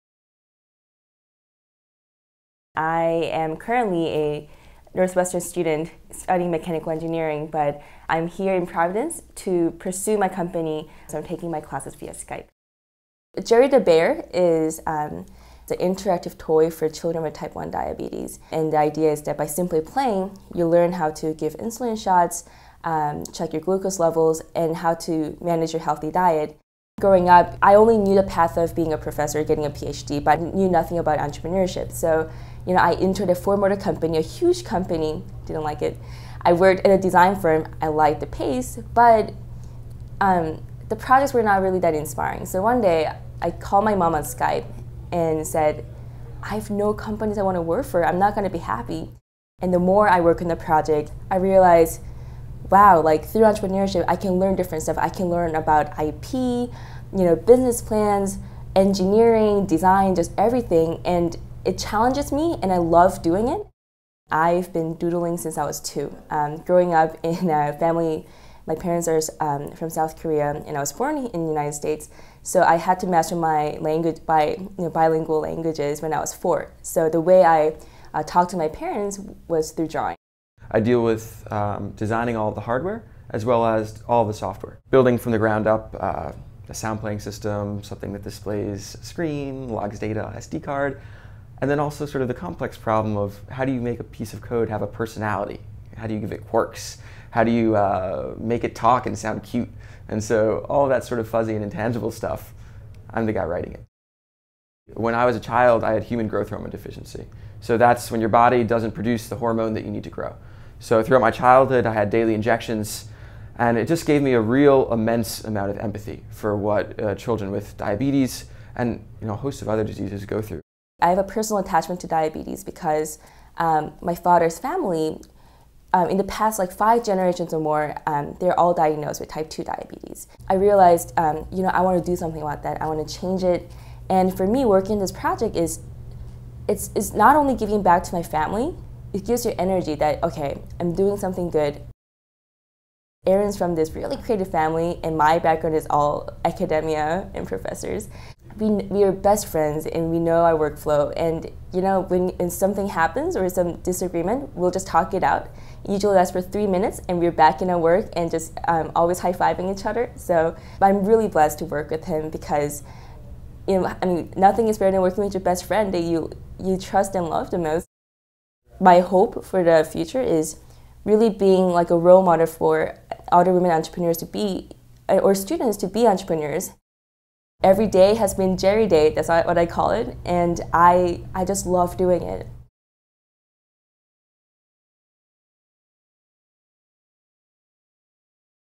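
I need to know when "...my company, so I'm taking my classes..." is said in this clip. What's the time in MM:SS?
00:10.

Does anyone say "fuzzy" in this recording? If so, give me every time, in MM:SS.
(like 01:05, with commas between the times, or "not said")
01:41.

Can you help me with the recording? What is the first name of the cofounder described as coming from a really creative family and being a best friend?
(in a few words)
Aaron.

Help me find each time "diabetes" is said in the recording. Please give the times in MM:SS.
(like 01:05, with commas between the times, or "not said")
00:17, 01:57, 02:02, 02:09.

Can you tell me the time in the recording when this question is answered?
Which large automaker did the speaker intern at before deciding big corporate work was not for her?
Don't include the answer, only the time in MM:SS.
00:33.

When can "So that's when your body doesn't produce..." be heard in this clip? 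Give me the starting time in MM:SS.
01:47.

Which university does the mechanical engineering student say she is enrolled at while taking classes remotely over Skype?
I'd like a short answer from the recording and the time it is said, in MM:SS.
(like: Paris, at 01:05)
Northwestern, at 00:04.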